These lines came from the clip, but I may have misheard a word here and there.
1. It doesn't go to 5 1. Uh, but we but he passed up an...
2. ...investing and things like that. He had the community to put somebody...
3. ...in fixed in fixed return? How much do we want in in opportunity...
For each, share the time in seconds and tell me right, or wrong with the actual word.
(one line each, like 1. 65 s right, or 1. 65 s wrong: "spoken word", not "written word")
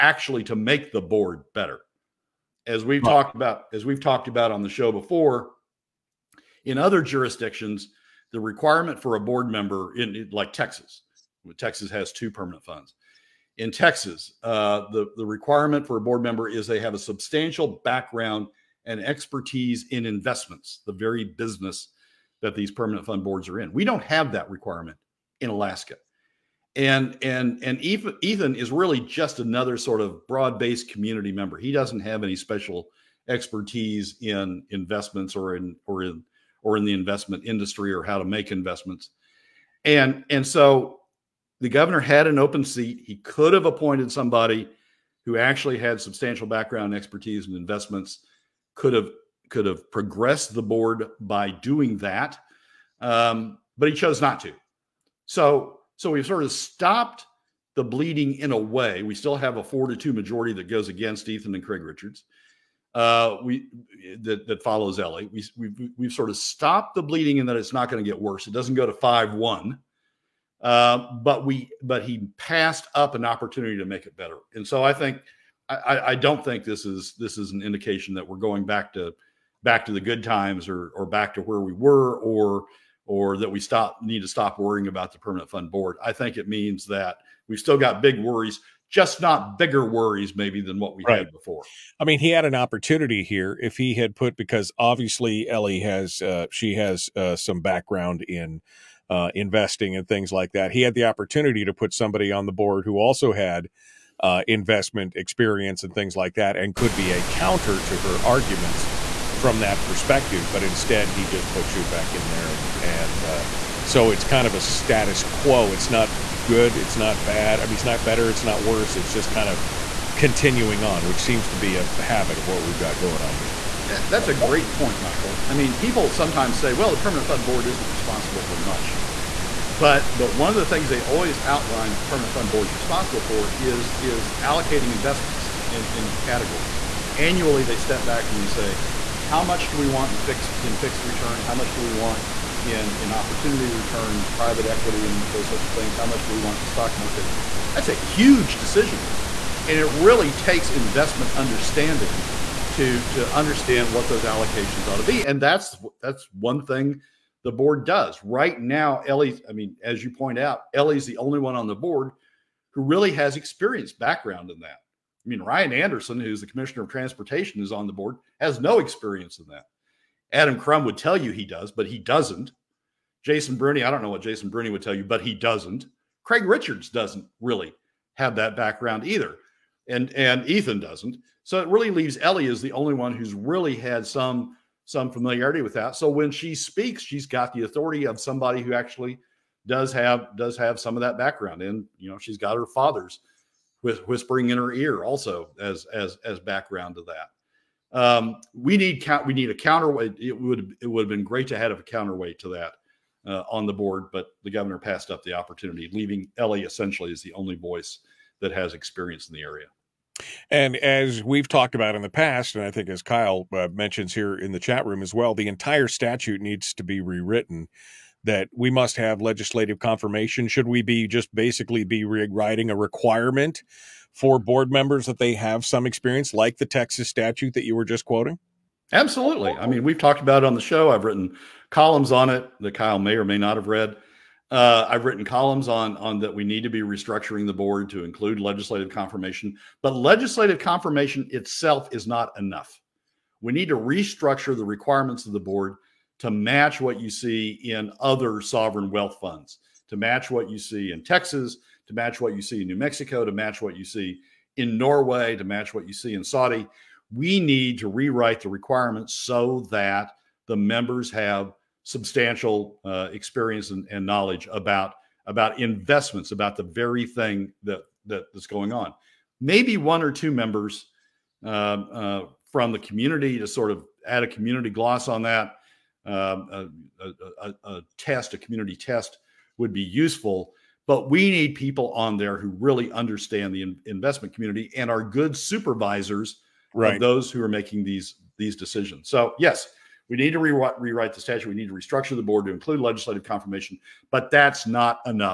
1. 68 s right
2. 99 s wrong: "opportunity", not "community"
3. 140 s right.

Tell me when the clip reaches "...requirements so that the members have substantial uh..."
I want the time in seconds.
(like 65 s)
258 s.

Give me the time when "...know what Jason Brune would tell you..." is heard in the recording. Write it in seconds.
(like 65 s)
174 s.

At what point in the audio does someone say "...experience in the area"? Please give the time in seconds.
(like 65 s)
208 s.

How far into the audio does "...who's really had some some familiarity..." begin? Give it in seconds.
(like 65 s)
183 s.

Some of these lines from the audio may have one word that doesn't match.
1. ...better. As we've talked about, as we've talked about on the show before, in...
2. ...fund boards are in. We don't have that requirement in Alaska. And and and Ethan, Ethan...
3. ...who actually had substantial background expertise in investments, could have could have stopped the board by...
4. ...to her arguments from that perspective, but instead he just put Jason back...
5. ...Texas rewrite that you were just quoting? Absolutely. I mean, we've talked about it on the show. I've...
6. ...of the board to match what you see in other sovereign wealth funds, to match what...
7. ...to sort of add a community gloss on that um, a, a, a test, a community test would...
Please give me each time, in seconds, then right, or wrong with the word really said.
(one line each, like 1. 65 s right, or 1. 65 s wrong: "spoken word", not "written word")
1. 1 s right
2. 23 s right
3. 45 s wrong: "progressed", not "stopped"
4. 107 s wrong: "Schutt", not "Jason"
5. 226 s wrong: "statute", not "rewrite"
6. 245 s right
7. 273 s right.